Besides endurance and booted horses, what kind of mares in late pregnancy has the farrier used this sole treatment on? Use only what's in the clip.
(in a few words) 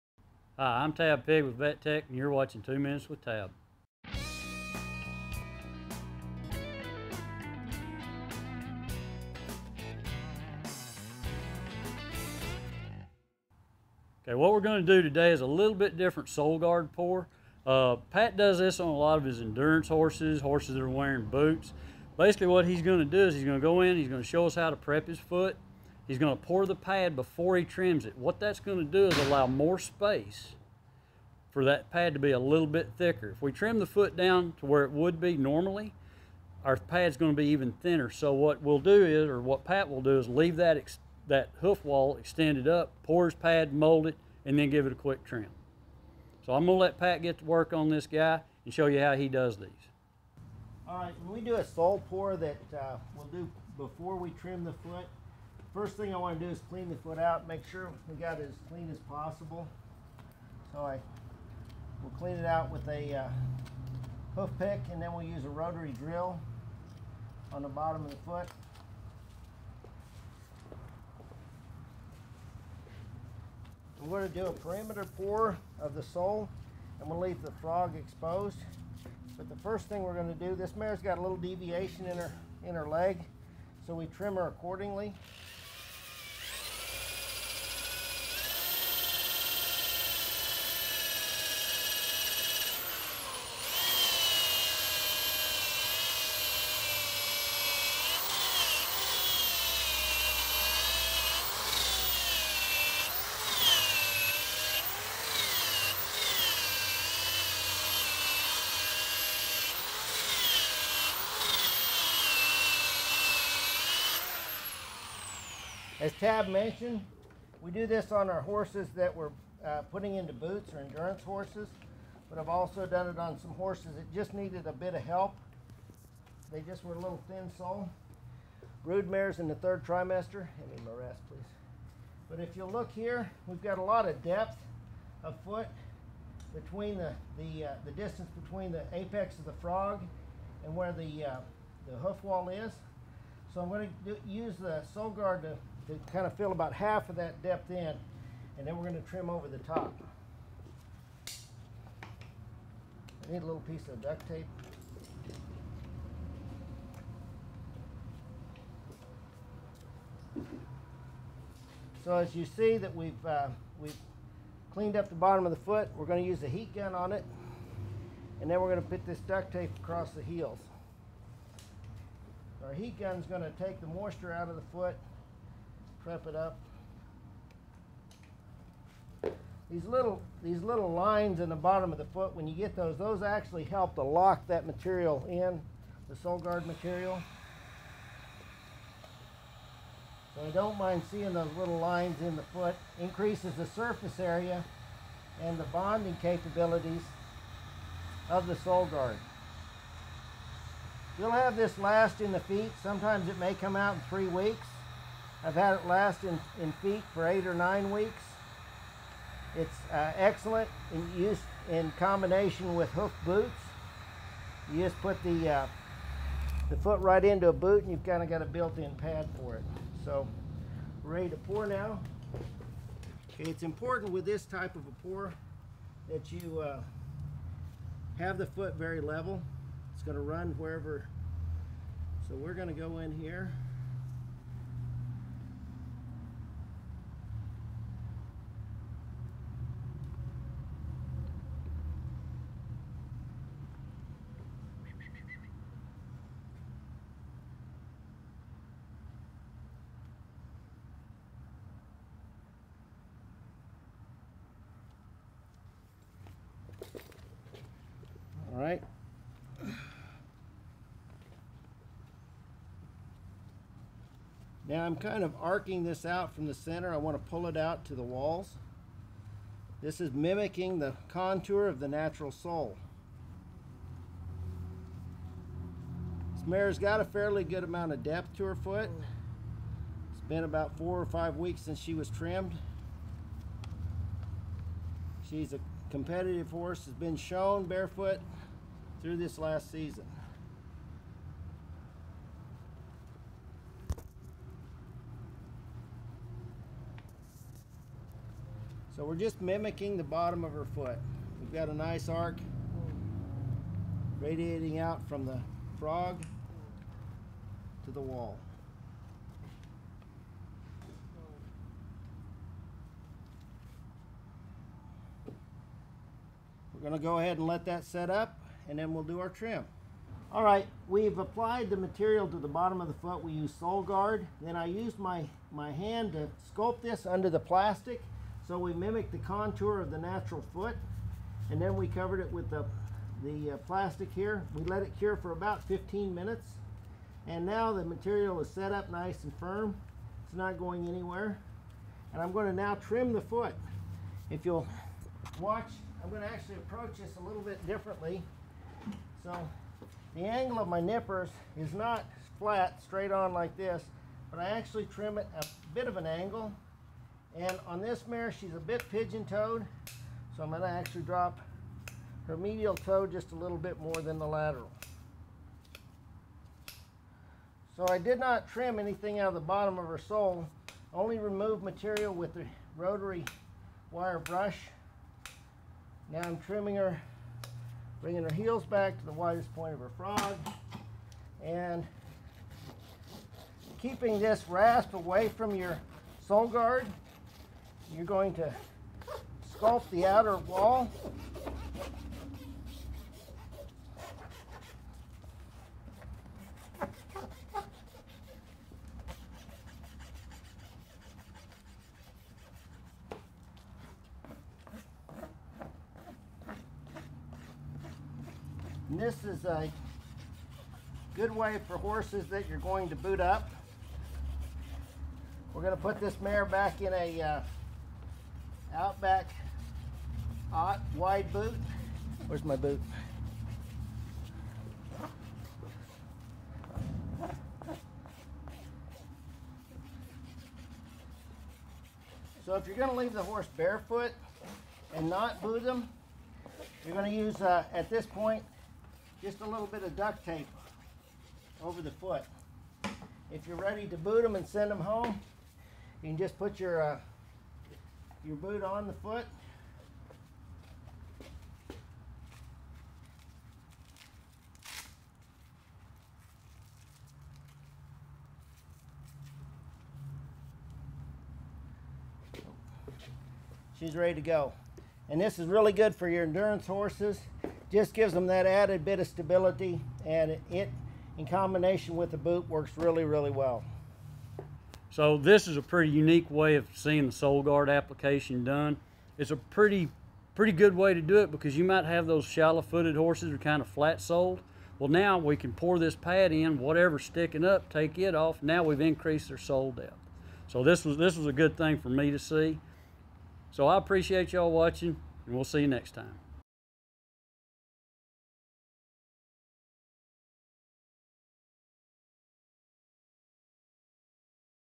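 Brood mares.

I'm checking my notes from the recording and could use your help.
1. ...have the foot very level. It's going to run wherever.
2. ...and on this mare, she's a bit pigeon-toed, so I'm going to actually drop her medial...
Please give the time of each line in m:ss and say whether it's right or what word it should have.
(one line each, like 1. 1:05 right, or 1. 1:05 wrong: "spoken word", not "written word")
1. 3:48 right
2. 5:57 right.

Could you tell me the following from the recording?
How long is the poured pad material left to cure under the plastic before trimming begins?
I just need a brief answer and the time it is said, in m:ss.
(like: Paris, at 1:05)
15 minutes, at 5:35.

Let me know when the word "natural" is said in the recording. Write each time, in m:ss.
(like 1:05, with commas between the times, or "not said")
4:31, 5:29.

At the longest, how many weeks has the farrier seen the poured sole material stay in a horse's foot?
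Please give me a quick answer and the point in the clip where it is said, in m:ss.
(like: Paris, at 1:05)
8 or 9 weeks, at 3:27.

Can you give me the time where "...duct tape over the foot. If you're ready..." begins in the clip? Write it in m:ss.
7:19.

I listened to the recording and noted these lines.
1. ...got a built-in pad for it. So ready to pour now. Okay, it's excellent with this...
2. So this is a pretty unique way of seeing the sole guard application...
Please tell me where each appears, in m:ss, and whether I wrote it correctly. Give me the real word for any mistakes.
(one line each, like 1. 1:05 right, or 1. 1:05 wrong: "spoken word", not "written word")
1. 3:38 wrong: "important", not "excellent"
2. 7:54 right.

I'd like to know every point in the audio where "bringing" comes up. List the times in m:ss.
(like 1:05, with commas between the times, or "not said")
6:18.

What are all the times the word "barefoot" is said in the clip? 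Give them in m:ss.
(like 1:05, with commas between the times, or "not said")
4:47, 7:13.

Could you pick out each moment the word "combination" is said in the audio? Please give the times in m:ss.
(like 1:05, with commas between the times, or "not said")
3:31, 7:51.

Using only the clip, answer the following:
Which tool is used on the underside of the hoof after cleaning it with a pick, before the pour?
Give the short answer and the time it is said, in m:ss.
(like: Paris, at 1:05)
rotary drill, at 1:05.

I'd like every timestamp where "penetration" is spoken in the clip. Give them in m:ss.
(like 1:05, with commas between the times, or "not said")
not said.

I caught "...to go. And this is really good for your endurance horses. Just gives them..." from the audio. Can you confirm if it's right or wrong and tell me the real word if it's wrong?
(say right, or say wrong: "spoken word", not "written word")
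right.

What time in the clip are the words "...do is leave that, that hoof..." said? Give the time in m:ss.
0:40.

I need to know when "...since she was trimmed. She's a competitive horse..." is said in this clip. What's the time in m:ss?
4:41.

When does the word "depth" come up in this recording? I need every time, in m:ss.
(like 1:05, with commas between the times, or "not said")
2:14, 2:27, 4:38, 8:09.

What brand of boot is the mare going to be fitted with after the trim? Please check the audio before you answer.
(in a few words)
Outback.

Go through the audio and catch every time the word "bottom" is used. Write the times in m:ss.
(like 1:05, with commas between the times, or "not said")
1:07, 2:45, 3:01, 5:00, 5:22, 6:09.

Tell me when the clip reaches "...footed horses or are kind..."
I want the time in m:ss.
8:02.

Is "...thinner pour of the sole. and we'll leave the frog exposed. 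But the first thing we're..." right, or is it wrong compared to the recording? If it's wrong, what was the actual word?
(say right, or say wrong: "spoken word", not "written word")
wrong: "perimeter", not "thinner".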